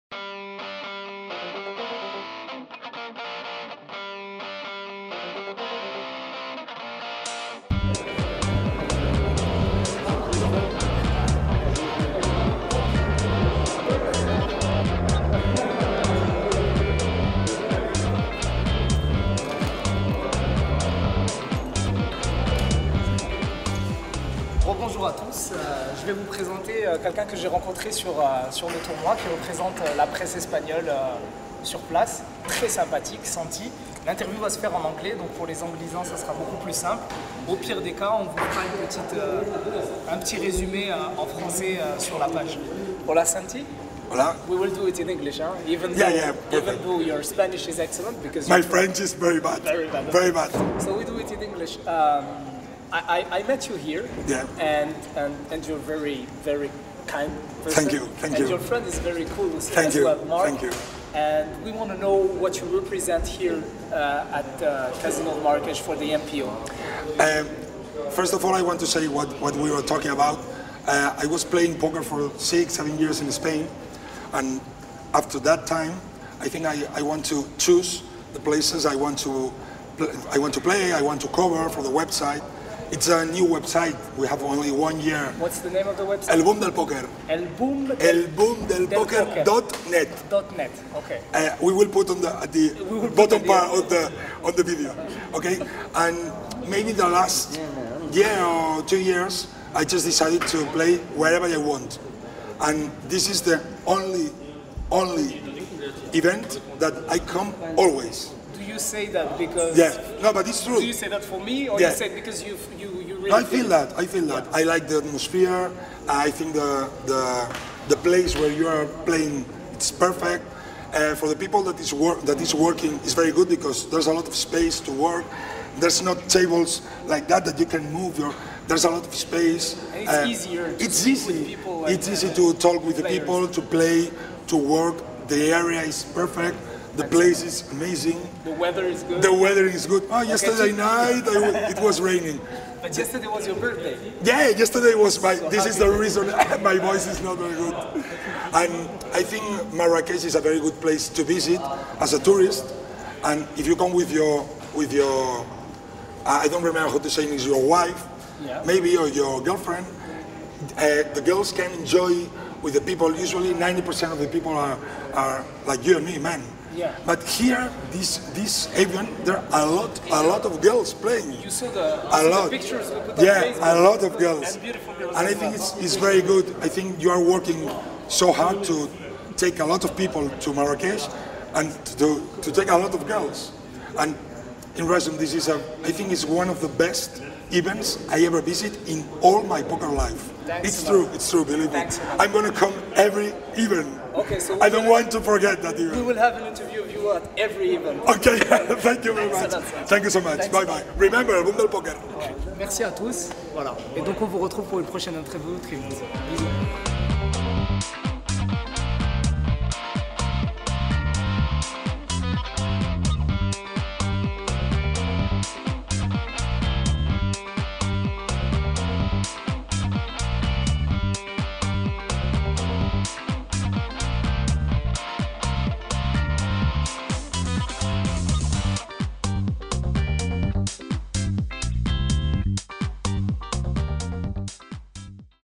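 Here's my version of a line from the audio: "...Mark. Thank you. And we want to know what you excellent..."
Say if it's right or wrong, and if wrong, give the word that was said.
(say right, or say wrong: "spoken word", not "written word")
wrong: "represent", not "excellent".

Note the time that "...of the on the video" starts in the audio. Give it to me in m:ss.
1:33.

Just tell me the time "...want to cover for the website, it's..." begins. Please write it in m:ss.
1:21.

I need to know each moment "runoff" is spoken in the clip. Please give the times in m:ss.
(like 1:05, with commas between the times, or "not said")
not said.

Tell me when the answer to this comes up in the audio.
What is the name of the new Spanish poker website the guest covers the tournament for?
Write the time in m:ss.
1:26.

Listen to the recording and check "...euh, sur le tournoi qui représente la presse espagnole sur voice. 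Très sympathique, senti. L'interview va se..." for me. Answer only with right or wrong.
wrong.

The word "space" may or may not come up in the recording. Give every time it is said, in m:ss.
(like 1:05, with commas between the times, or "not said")
2:04, 2:09.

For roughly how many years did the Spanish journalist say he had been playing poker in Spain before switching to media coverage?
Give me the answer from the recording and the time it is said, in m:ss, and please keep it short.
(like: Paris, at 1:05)
six, seven years, at 1:12.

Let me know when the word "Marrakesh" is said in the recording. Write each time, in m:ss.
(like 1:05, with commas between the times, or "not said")
1:05, 2:29, 3:00.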